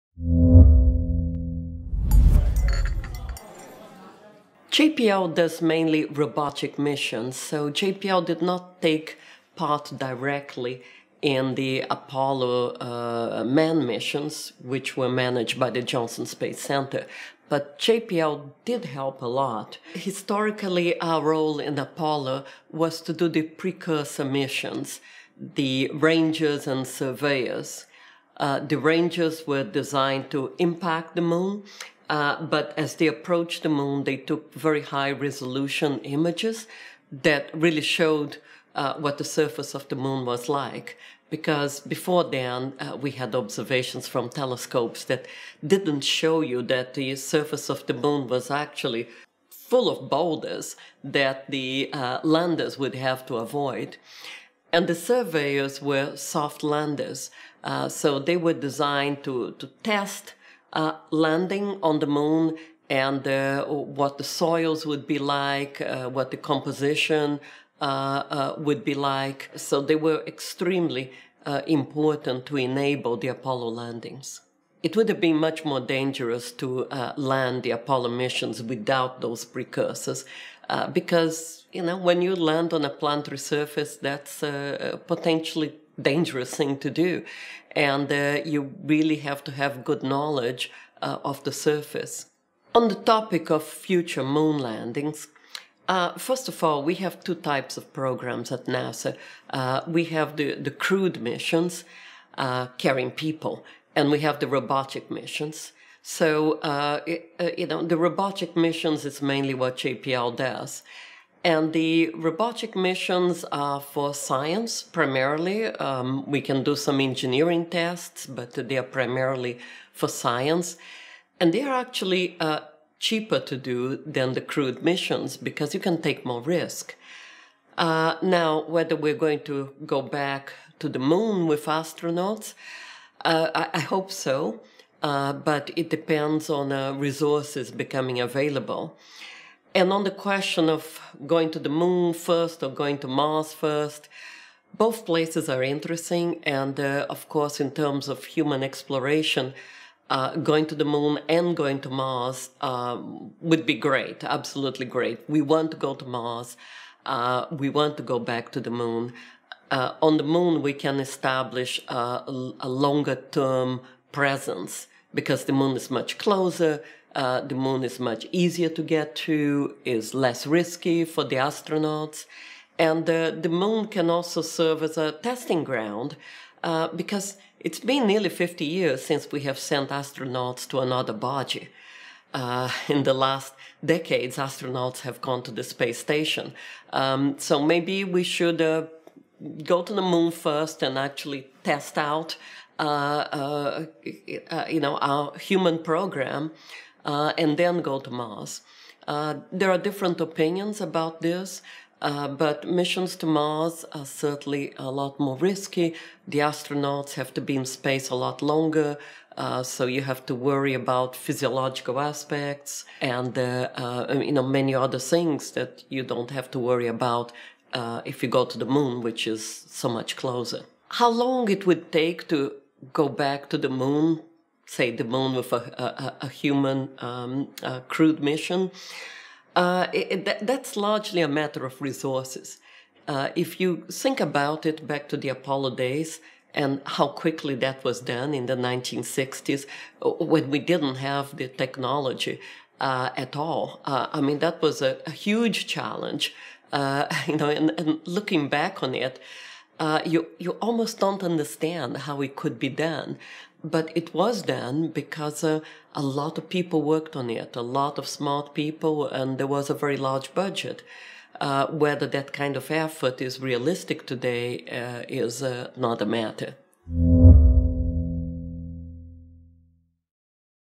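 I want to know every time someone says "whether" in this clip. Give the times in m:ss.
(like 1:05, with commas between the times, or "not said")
2:08, 4:21.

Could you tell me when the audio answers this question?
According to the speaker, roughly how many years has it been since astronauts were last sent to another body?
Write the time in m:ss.
2:58.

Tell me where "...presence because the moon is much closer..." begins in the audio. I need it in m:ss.
2:44.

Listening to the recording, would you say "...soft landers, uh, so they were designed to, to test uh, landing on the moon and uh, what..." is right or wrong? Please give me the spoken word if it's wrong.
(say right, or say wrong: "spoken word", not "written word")
right.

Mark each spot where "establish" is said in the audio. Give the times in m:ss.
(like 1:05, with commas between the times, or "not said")
2:40.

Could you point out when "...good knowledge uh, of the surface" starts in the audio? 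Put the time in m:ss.
1:29.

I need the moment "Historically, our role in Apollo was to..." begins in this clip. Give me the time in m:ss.
0:19.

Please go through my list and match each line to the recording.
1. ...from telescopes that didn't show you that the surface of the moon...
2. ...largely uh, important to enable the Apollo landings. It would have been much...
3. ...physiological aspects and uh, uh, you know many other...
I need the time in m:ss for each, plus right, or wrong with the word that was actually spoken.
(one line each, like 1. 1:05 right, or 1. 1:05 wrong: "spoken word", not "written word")
1. 0:44 right
2. 1:10 wrong: "extremely", not "largely"
3. 3:31 right.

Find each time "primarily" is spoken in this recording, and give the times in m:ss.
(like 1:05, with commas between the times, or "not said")
1:54, 1:58.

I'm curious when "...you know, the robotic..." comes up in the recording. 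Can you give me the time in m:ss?
1:47.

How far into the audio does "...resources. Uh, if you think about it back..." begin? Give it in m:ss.
3:51.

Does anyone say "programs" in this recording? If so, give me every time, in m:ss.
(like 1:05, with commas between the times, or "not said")
1:37, 3:15.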